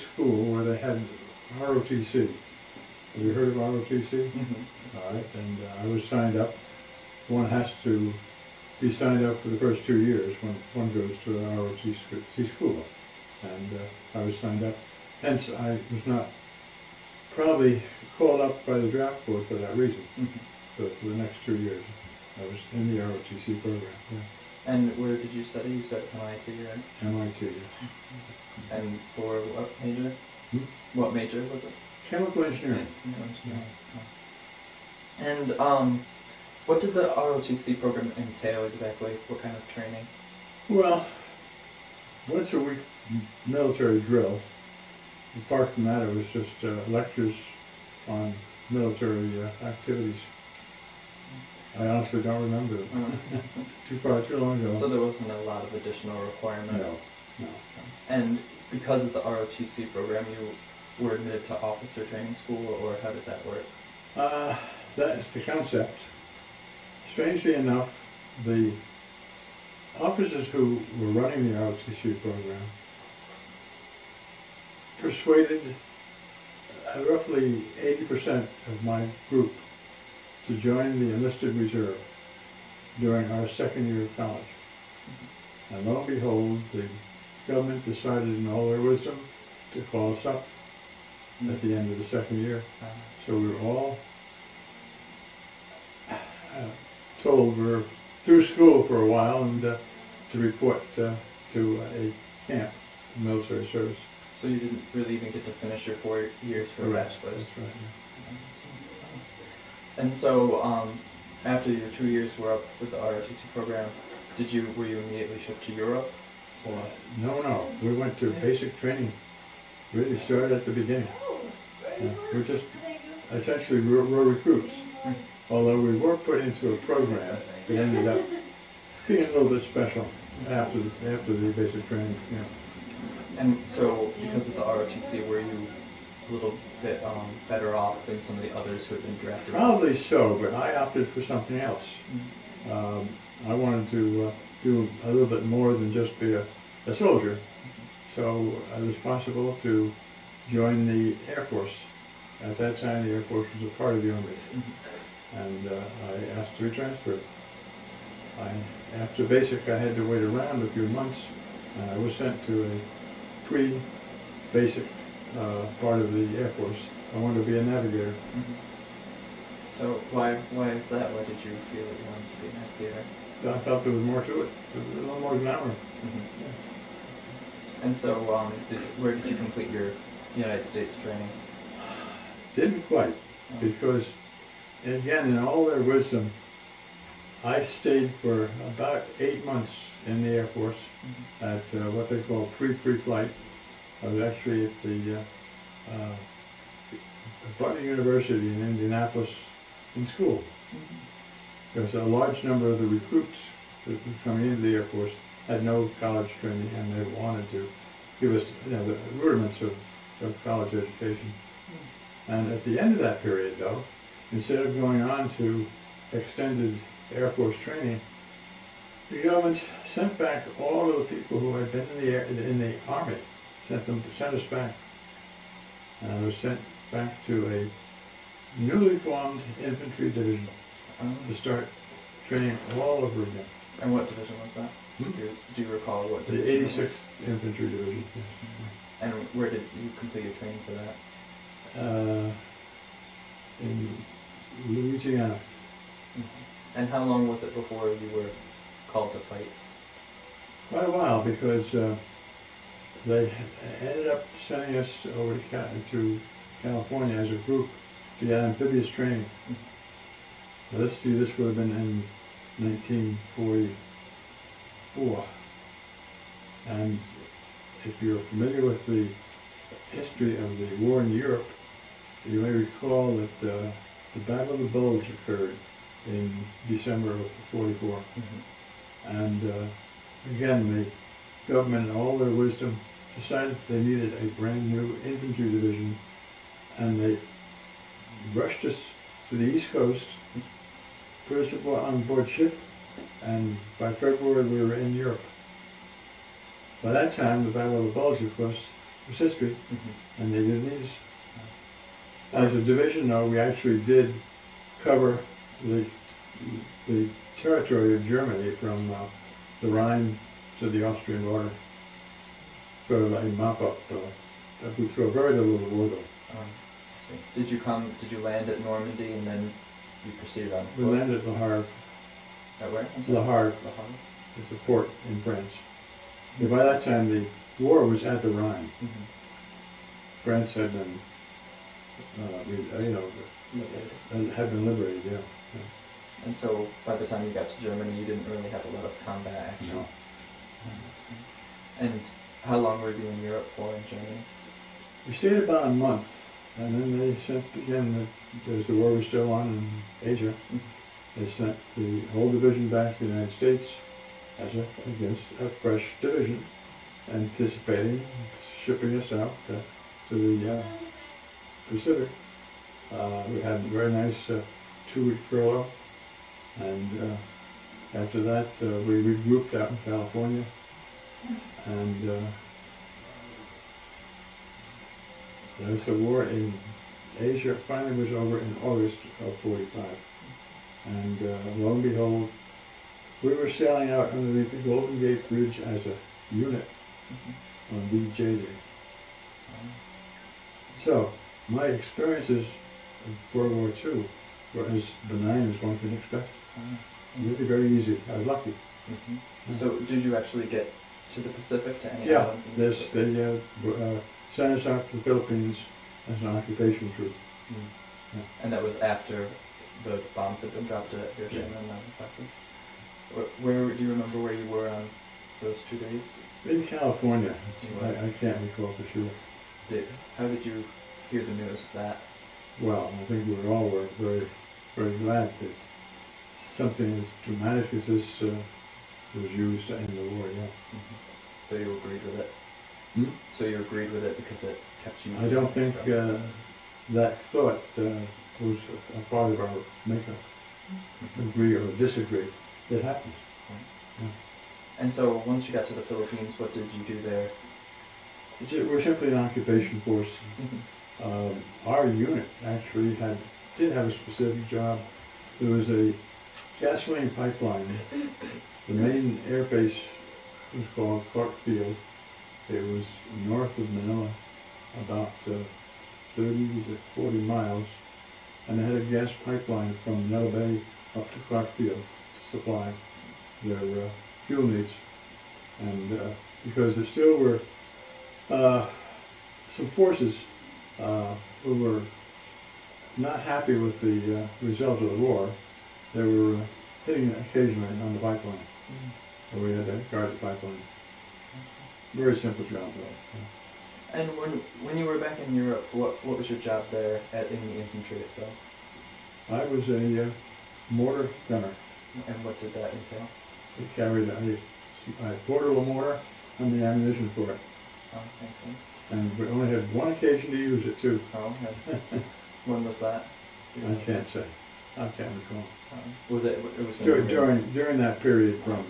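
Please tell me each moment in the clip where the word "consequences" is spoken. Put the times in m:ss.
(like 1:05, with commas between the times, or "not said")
not said.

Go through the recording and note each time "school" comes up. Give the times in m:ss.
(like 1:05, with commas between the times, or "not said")
0:12, 1:02, 1:38, 3:20.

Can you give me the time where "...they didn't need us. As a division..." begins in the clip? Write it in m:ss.
5:00.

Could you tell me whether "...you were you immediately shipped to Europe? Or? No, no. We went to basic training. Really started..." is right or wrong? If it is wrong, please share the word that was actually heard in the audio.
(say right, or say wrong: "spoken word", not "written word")
right.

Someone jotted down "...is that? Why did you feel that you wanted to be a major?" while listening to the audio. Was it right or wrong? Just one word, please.
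wrong.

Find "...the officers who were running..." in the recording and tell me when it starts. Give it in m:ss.
1:08.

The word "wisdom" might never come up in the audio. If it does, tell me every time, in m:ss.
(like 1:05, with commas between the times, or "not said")
1:28, 3:05, 4:42.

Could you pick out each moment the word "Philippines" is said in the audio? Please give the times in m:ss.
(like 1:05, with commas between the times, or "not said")
6:45, 7:25.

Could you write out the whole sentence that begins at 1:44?
So you didn't really even get to finish your four years for Correct.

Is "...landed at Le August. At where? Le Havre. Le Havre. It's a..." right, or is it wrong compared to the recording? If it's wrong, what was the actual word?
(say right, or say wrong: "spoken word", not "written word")
wrong: "Havre", not "August".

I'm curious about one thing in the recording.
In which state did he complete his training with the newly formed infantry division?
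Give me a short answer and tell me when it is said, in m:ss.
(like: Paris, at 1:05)
Louisiana, at 4:04.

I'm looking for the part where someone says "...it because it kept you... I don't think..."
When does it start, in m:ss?
7:14.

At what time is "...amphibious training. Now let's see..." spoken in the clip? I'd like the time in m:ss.
4:18.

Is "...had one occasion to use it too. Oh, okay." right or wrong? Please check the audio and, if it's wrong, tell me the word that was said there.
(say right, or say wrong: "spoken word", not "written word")
right.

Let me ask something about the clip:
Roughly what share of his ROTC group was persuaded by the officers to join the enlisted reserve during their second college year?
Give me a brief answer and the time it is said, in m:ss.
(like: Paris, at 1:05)
80%, at 1:17.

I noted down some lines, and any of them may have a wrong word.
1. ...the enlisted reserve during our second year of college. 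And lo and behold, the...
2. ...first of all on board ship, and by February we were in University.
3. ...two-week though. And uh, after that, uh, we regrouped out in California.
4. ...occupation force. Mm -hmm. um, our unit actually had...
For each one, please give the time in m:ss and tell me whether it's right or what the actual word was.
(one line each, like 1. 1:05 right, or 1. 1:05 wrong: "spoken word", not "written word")
1. 1:20 right
2. 4:51 wrong: "Europe", not "University"
3. 6:04 wrong: "furlough", not "though"
4. 7:29 right.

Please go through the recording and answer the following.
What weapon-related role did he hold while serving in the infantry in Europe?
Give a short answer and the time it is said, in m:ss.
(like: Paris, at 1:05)
Mortar gunner, at 8:20.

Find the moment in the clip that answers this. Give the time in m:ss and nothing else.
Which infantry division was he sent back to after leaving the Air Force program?
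3:56.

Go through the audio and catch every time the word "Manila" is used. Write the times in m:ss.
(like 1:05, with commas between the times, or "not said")
7:43, 7:50.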